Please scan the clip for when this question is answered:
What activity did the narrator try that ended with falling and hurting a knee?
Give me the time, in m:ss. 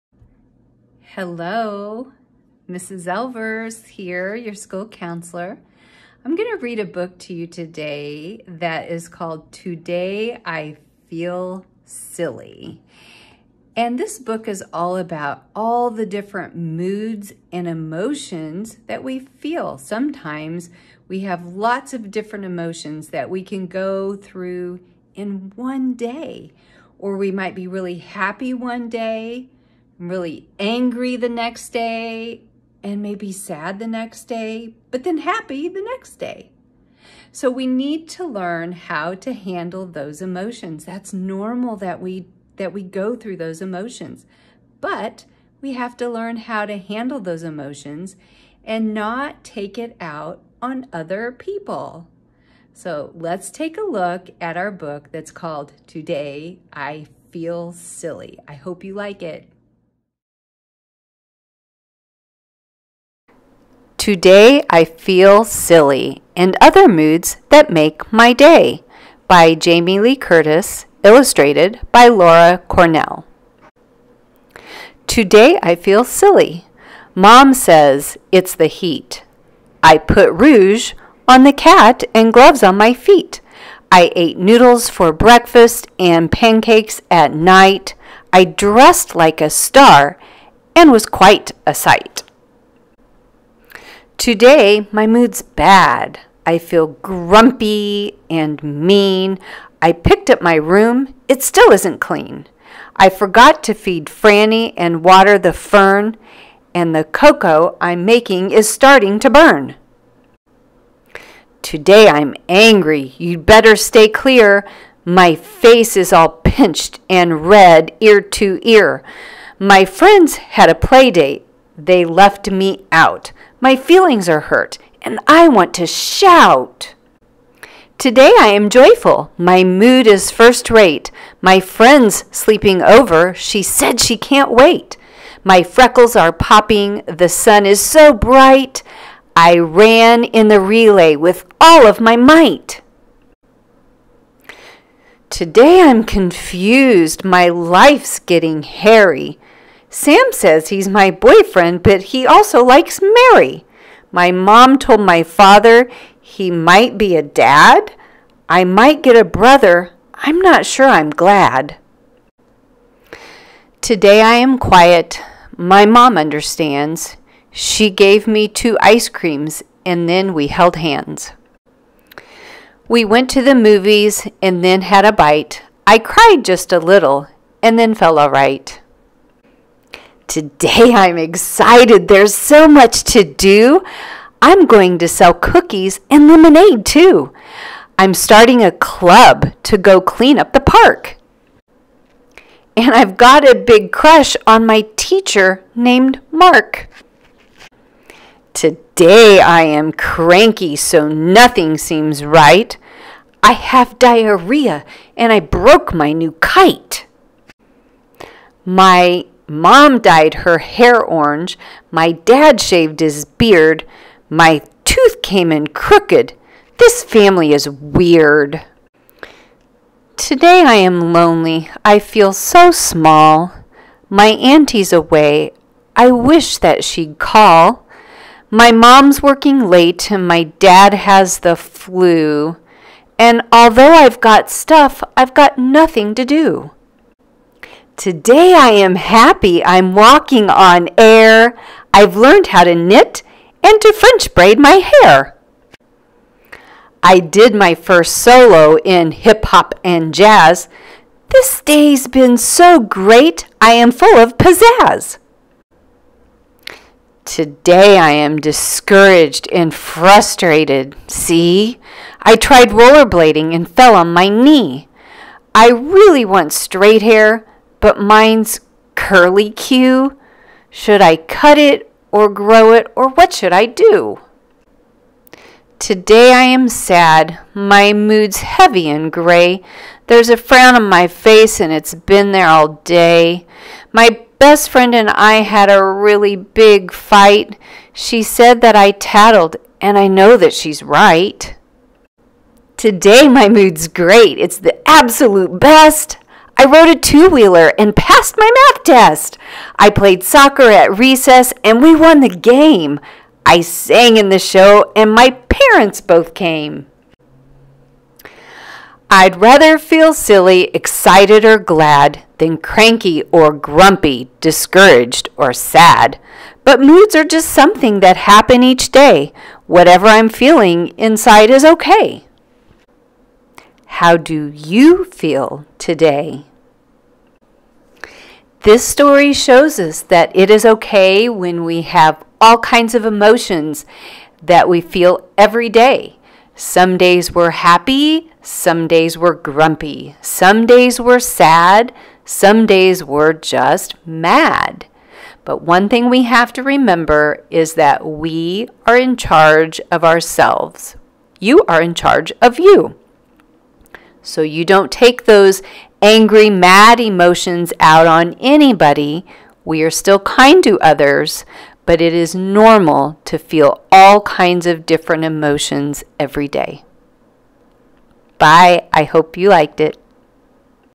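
4:22.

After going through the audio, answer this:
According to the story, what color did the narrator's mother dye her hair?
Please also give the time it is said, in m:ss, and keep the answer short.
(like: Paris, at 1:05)
Orange, at 3:31.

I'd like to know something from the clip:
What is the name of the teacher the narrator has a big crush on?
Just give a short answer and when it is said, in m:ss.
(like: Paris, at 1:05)
Mark, at 3:16.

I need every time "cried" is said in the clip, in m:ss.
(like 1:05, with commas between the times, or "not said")
2:55.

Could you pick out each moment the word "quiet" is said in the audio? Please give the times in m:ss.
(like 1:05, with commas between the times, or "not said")
2:44.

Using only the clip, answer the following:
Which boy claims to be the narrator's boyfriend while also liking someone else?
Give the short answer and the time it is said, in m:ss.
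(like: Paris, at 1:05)
Sam, at 2:29.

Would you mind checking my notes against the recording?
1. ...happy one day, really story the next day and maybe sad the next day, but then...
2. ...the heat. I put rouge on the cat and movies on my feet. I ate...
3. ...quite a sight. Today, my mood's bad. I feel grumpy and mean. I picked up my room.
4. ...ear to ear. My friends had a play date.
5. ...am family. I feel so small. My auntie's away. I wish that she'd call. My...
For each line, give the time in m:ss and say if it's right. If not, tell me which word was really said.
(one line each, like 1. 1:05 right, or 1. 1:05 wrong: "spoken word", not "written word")
1. 0:27 wrong: "angry", not "story"
2. 1:18 wrong: "gloves", not "movies"
3. 1:31 right
4. 1:57 right
5. 3:40 wrong: "lonely", not "family".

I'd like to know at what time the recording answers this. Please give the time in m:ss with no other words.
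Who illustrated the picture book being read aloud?
1:12.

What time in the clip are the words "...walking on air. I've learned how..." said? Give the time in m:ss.
3:59.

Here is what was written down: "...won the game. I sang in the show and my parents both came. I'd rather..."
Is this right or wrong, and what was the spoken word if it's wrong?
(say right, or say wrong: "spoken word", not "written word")
right.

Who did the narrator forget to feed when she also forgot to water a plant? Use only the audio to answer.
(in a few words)
Franny.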